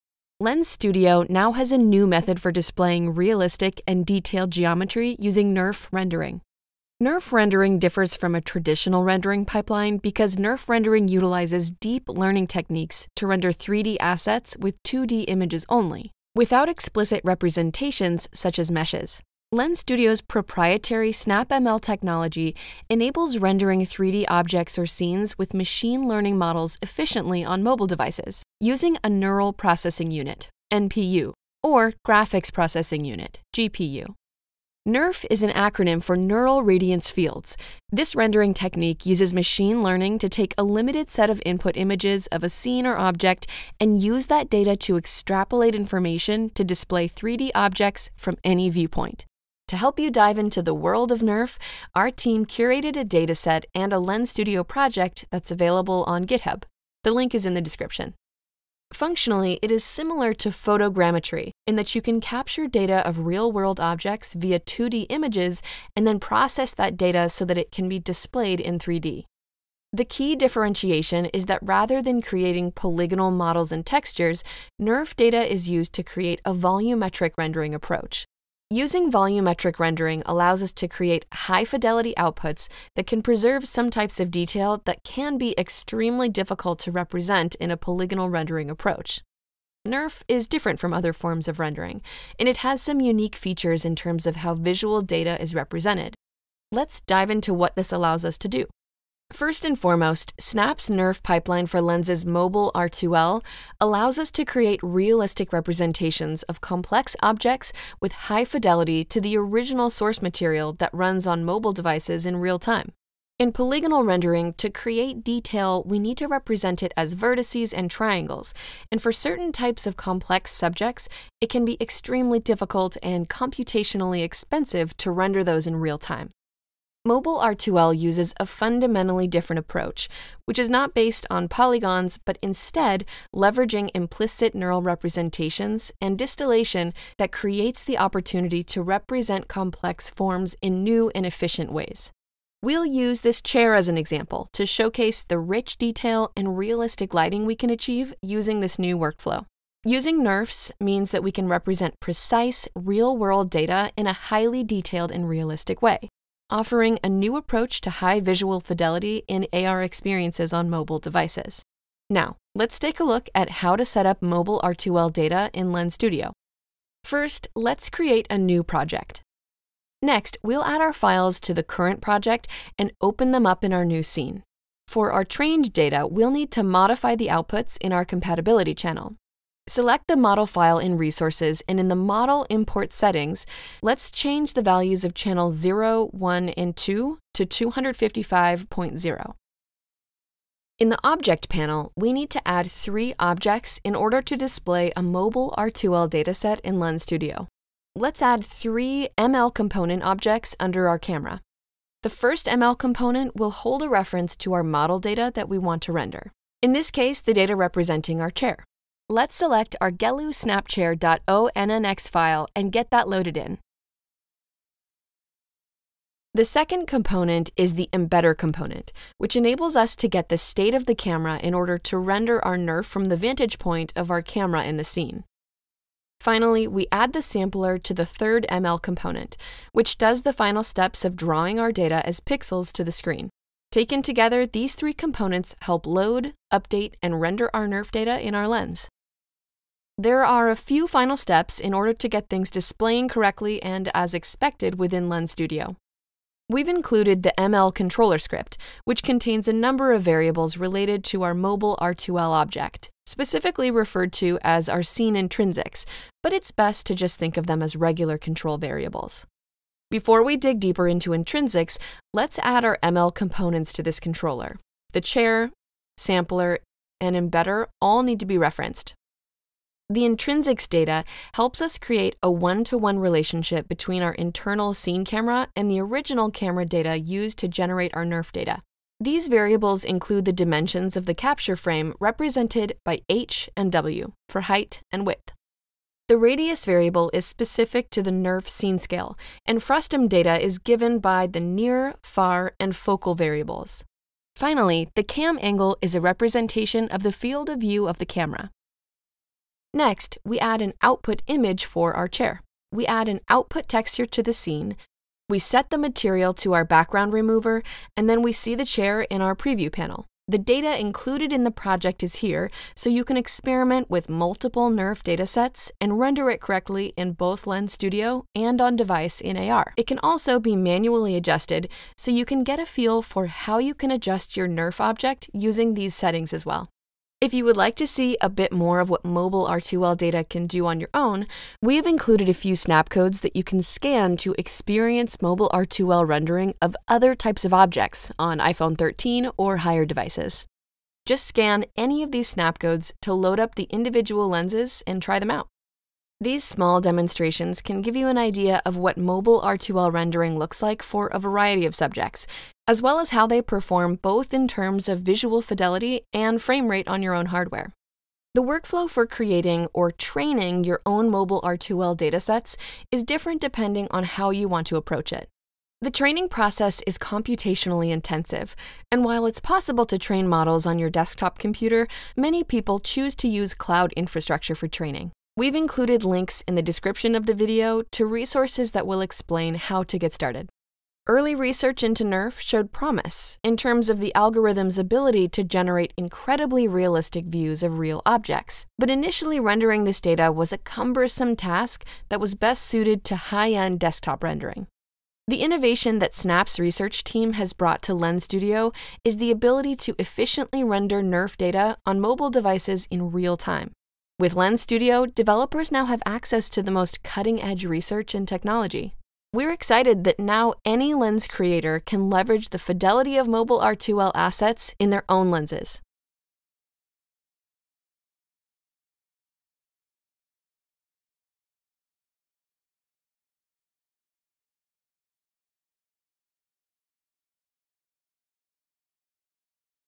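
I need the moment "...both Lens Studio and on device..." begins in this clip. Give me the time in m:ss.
5:17.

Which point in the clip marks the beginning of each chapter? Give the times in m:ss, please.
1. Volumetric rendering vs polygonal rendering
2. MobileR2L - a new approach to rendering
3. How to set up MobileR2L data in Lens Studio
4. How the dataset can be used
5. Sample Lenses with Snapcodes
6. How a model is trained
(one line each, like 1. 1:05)
1. 1:10
2. 2:07
3. 2:43
4. 3:15
5. 5:27
6. 5:58.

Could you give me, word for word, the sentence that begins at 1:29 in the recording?
NERF is different from other forms of rendering, and it has some unique features in terms of how visual data is represented.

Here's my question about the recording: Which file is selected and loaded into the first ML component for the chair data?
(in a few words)
Gelu file.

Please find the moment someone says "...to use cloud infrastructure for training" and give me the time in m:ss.
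6:13.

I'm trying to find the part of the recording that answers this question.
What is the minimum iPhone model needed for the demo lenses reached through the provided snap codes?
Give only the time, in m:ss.
5:38.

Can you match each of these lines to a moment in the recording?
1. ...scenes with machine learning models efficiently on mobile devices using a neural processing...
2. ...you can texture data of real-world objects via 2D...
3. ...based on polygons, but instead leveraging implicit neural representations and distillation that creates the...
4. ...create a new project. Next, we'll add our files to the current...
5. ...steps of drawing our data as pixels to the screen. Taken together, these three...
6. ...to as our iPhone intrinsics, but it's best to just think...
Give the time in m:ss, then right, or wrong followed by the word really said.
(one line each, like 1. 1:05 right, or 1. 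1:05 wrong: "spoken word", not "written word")
1. 0:24 right
2. 1:01 wrong: "capture", not "texture"
3. 2:10 right
4. 2:47 right
5. 3:50 right
6. 4:14 wrong: "scene", not "iPhone".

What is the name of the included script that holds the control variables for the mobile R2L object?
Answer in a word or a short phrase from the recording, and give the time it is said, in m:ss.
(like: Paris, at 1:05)
ML controller script, at 4:07.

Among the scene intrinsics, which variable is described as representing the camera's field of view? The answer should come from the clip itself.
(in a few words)
cam angle.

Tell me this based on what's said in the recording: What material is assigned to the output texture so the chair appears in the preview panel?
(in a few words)
background remover.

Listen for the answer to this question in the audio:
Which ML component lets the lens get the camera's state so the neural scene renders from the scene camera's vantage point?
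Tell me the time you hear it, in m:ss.
3:37.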